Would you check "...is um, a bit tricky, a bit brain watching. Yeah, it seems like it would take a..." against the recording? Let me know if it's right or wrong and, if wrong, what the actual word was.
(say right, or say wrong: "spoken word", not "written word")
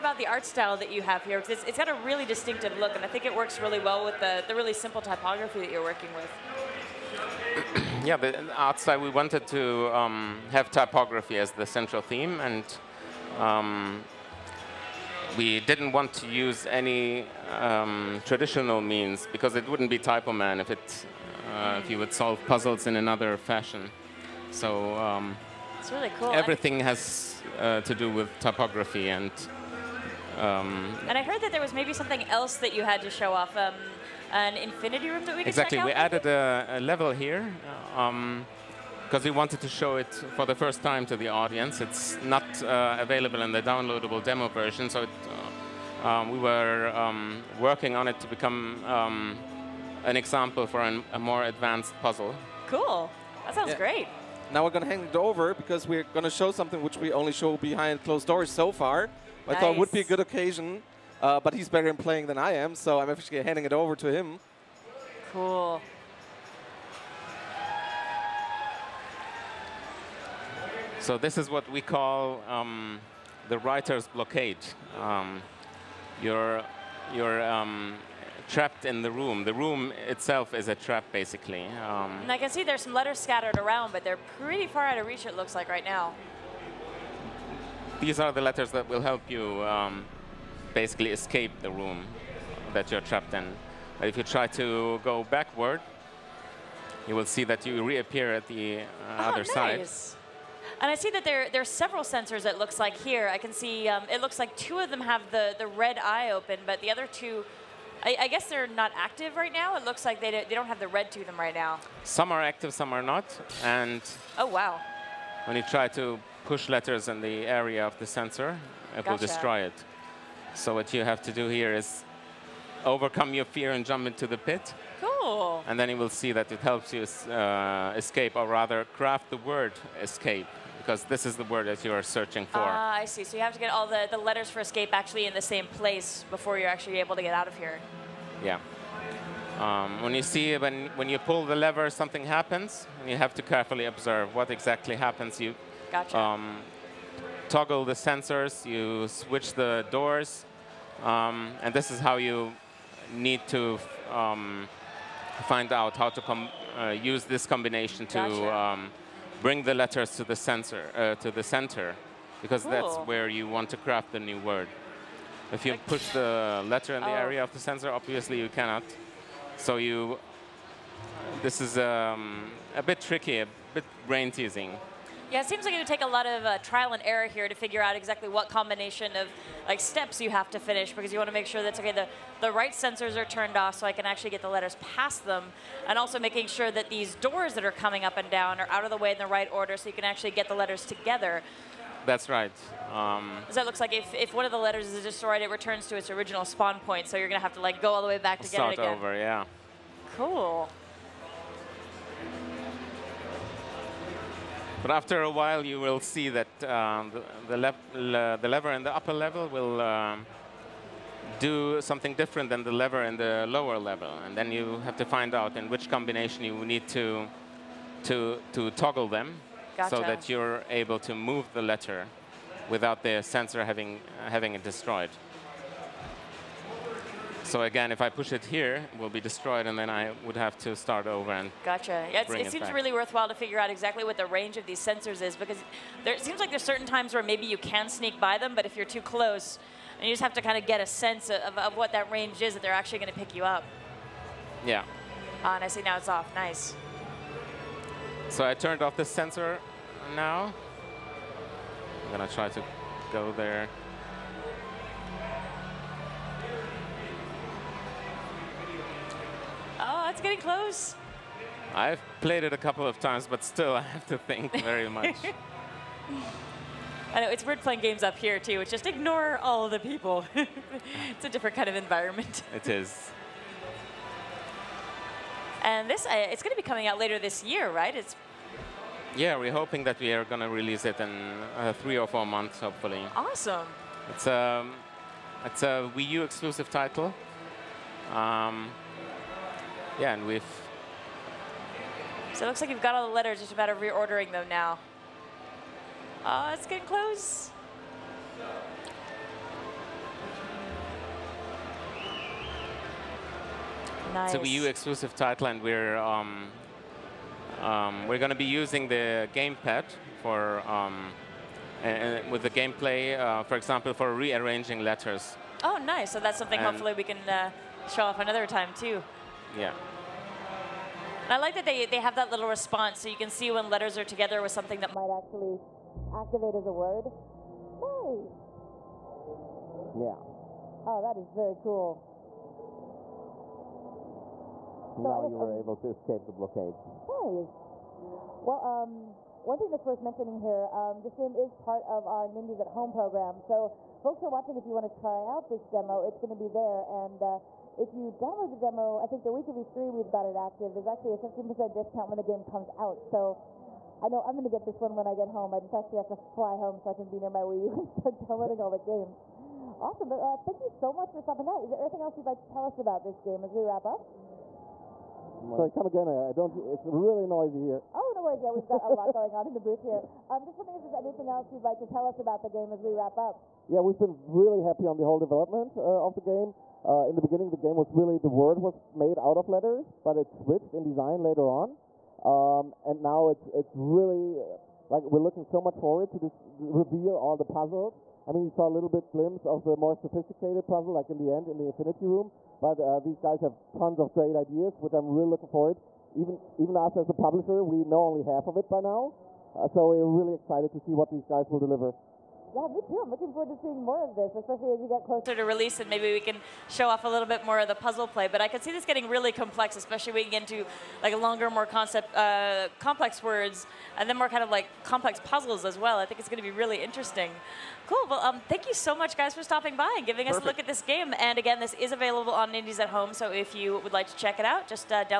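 wrong: "teasing", not "watching".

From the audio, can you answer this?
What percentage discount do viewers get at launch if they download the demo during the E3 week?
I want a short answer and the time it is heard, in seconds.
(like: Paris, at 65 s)
15%, at 351 s.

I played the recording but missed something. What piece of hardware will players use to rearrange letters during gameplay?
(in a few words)
the gamepad.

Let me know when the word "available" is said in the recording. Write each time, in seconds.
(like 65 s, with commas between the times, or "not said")
42 s, 421 s.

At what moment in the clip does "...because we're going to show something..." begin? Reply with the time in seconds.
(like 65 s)
55 s.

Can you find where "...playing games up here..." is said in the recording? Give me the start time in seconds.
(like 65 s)
267 s.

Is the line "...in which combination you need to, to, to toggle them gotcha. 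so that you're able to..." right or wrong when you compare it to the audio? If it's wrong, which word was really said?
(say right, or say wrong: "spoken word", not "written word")
right.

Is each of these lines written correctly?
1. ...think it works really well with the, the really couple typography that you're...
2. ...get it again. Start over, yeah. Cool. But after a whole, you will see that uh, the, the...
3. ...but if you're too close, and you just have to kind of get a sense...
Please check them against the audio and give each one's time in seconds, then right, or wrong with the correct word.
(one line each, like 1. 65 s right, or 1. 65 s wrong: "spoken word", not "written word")
1. 3 s wrong: "simple", not "couple"
2. 198 s wrong: "while", not "whole"
3. 238 s right.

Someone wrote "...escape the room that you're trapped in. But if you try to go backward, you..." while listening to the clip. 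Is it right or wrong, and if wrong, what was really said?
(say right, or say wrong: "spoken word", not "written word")
right.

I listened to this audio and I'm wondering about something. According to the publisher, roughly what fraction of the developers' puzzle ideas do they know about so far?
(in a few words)
half.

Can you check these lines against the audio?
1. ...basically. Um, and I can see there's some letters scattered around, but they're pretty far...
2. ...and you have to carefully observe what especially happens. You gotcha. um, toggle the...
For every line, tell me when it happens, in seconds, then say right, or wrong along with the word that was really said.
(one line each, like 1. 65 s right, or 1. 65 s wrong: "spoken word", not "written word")
1. 81 s right
2. 143 s wrong: "exactly", not "especially".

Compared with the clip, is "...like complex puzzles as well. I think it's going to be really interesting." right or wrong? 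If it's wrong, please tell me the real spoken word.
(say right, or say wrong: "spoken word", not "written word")
right.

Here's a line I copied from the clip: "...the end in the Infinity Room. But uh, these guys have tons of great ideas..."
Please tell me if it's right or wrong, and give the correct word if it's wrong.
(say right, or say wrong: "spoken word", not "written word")
right.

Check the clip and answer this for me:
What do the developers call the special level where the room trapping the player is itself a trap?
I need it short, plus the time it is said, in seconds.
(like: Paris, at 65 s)
the writer's blockade, at 73 s.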